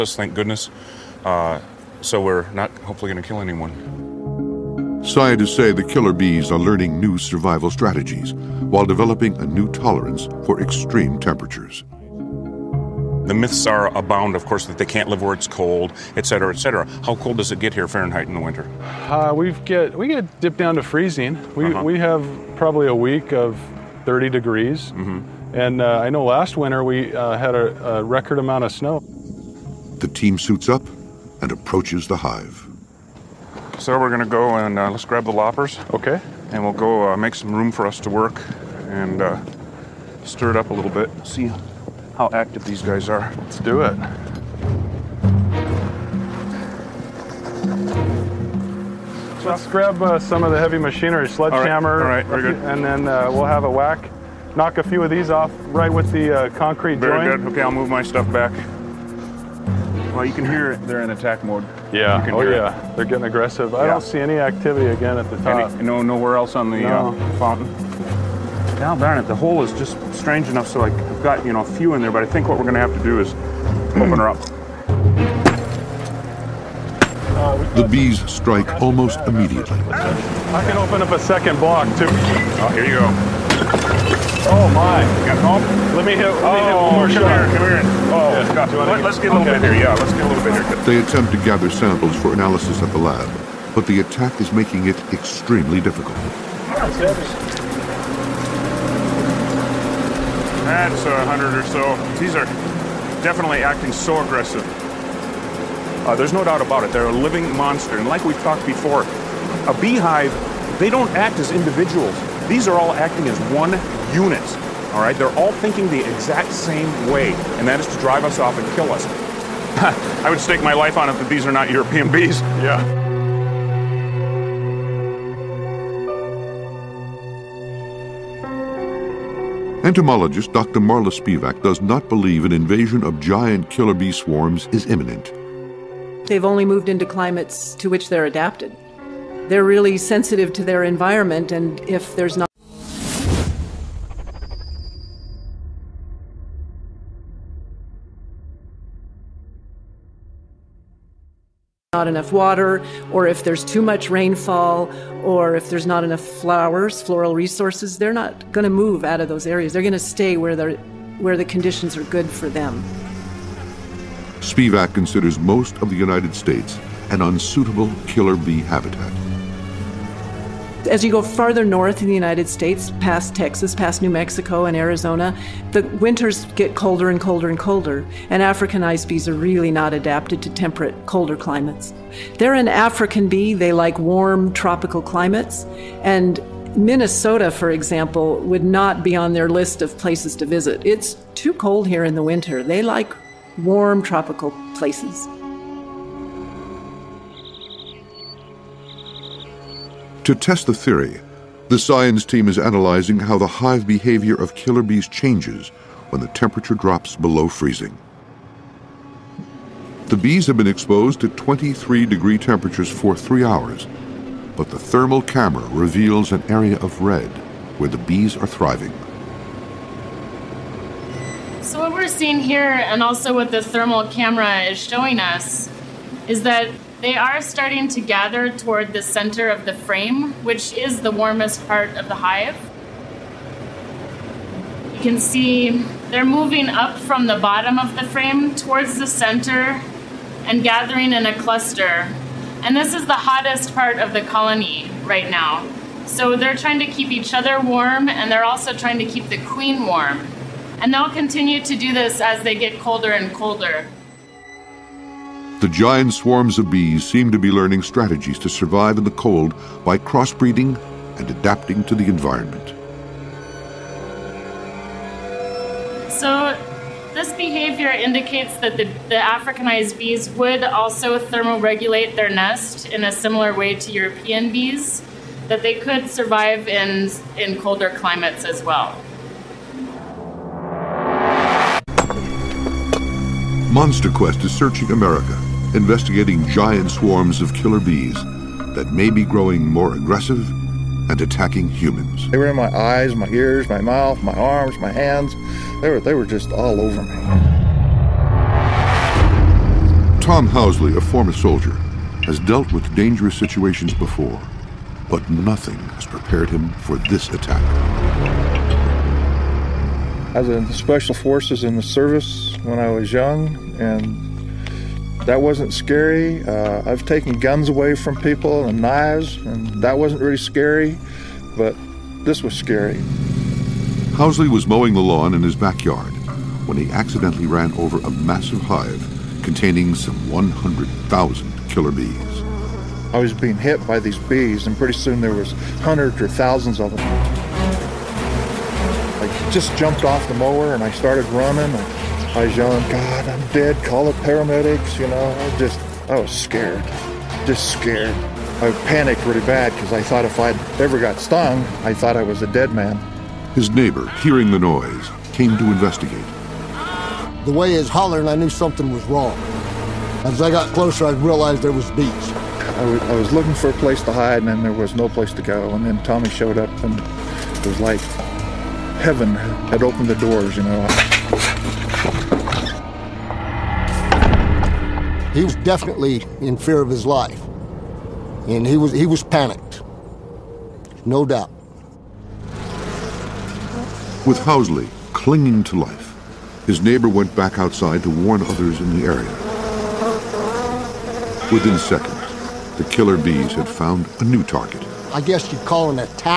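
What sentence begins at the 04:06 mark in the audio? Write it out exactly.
So they're trying to keep each other warm and they're also trying to keep the queen warm.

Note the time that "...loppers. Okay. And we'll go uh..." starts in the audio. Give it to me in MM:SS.
00:35.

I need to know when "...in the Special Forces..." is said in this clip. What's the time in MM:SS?
05:10.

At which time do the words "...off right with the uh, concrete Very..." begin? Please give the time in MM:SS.
00:55.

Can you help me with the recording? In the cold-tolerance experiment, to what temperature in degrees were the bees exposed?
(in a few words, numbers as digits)
23 degrees.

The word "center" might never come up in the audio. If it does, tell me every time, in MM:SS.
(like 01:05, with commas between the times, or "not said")
03:49, 03:59.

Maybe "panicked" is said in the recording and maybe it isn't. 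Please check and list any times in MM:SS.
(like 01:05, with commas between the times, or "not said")
05:48, 06:19.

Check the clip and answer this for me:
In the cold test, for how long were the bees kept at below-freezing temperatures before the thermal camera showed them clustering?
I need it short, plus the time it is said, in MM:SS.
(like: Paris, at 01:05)
three hours, at 03:33.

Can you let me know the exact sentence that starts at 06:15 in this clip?
he was definitely in fear of his life.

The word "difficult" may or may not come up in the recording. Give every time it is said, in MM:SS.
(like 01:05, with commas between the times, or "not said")
01:35.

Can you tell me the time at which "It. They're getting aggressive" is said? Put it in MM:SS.
01:02.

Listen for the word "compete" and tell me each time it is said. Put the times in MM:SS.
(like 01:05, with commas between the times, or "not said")
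not said.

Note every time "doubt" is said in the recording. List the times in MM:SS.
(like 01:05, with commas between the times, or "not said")
01:46, 06:21.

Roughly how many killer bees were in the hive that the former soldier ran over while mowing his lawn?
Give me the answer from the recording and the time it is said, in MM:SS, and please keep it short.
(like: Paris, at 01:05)
100,000, at 05:30.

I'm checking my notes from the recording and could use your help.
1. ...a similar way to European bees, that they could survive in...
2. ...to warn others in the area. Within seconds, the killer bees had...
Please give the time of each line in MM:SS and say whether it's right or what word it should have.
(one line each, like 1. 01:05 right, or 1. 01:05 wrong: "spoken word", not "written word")
1. 04:33 right
2. 06:28 right.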